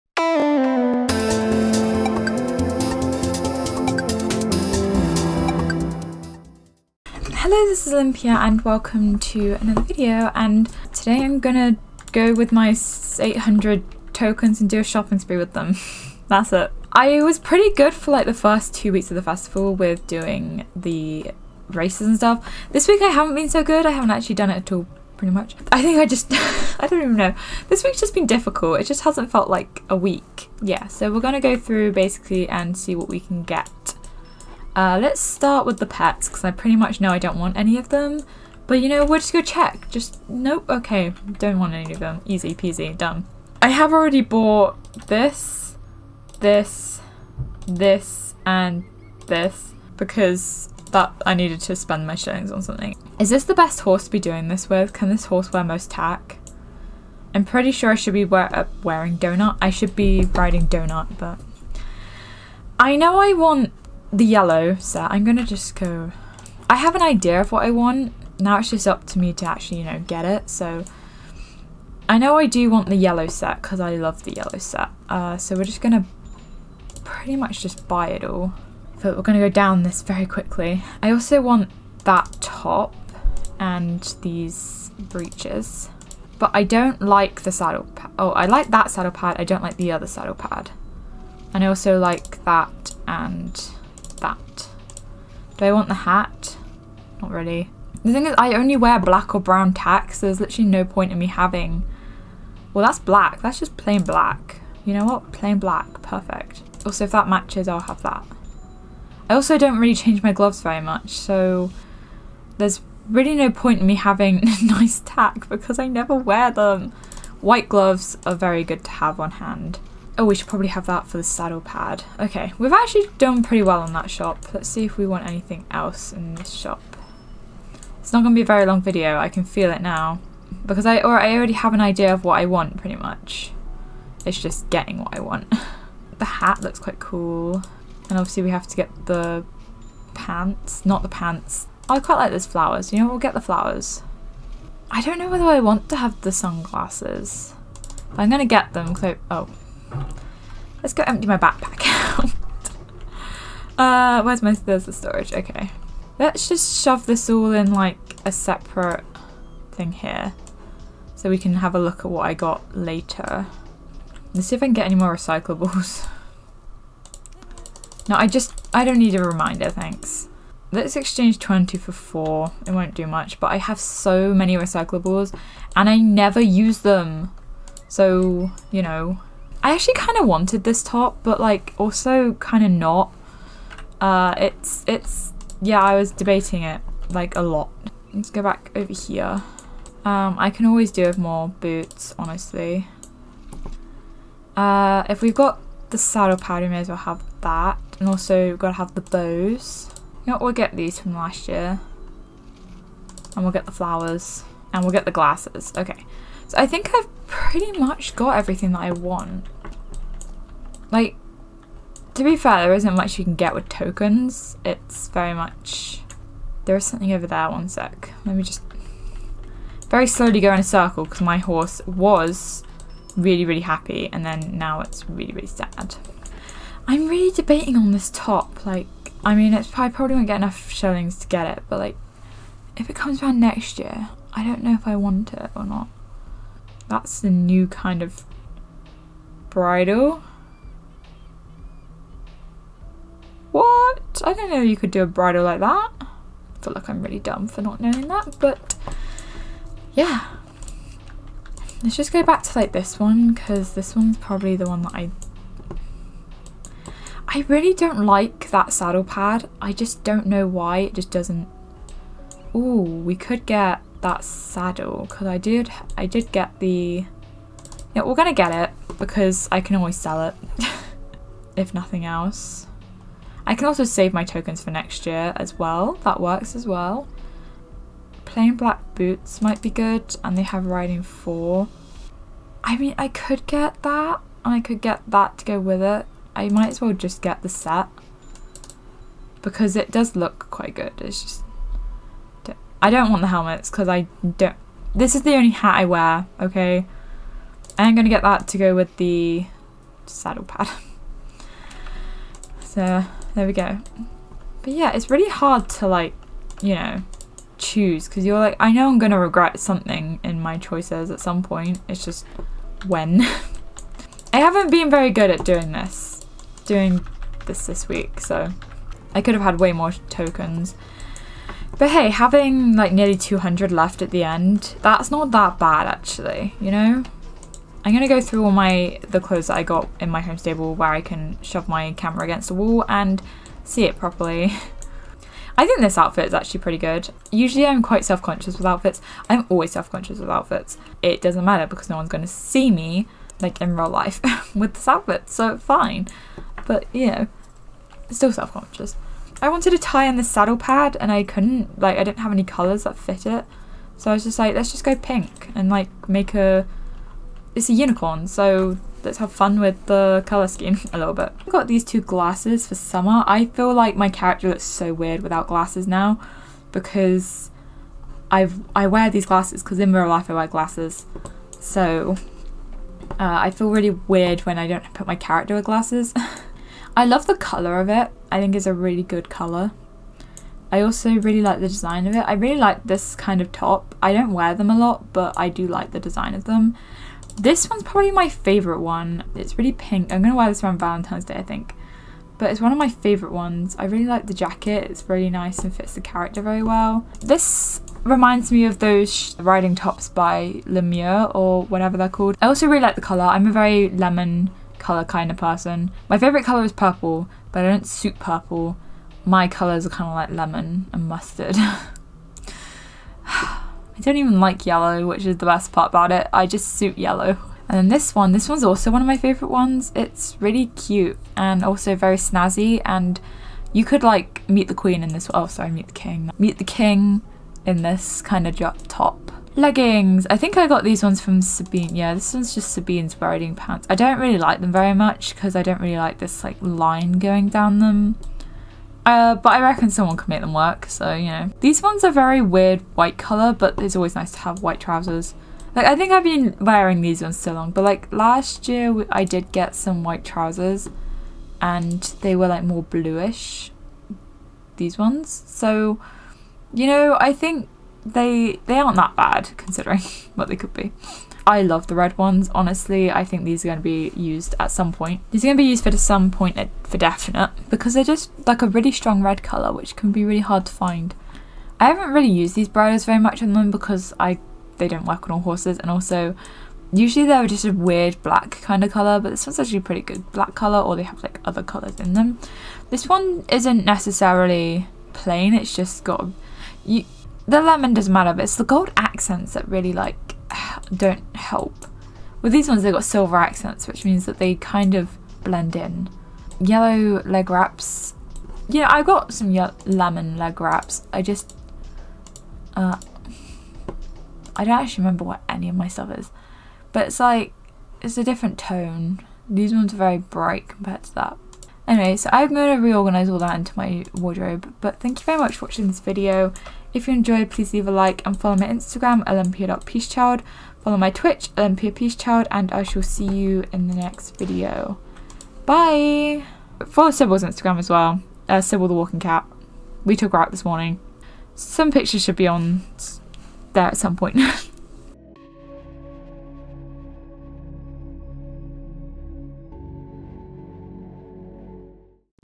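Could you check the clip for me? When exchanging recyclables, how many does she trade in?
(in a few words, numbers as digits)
20.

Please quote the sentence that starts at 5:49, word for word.
I wanted a tie in the saddle pad and I couldn't.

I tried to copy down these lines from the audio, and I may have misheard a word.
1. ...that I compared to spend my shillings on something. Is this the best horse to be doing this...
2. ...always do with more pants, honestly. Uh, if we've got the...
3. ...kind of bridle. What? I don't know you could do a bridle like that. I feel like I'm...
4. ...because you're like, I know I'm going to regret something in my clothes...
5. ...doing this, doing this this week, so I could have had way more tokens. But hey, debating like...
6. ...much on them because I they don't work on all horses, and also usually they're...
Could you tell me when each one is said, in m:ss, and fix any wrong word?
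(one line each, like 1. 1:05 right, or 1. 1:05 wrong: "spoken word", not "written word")
1. 0:50 wrong: "needed", not "compared"
2. 3:10 wrong: "boots", not "pants"
3. 3:57 right
4. 5:08 wrong: "choices", not "clothes"
5. 5:15 wrong: "having", not "debating"
6. 7:53 right.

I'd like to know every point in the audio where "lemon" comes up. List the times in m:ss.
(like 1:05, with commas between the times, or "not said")
6:43, 6:50, 8:07, 8:19.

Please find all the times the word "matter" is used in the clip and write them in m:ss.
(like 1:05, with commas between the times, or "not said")
5:41, 8:08.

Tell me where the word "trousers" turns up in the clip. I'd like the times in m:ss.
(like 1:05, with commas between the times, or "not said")
7:24, 7:30.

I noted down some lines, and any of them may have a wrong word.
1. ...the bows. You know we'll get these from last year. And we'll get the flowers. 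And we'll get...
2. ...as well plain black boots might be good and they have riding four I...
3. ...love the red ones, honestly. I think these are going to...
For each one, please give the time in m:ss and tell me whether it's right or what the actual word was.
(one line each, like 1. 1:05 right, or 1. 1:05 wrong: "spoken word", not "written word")
1. 3:18 right
2. 4:36 right
3. 7:41 right.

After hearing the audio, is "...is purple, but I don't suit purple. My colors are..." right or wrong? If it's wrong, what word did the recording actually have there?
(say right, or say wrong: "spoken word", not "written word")
right.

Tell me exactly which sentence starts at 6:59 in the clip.
It's really cute and also very snazzy and you could like meet the queen in this, oh sorry, meet the king.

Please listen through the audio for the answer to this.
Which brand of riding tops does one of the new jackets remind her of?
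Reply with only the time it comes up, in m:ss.
6:40.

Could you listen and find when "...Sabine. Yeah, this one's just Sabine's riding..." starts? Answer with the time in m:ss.
7:11.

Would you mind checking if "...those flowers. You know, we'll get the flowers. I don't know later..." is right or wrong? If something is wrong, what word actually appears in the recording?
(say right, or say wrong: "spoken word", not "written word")
wrong: "whether", not "later".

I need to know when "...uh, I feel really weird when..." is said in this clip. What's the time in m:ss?
6:13.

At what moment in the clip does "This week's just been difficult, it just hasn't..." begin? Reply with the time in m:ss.
0:27.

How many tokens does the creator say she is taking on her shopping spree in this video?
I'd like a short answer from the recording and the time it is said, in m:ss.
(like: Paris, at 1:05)
800, at 0:13.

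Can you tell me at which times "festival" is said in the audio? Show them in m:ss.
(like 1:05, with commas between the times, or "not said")
0:19.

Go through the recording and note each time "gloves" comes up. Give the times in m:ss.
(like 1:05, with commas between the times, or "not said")
1:50, 1:57.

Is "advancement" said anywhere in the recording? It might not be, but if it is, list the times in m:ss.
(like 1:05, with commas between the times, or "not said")
not said.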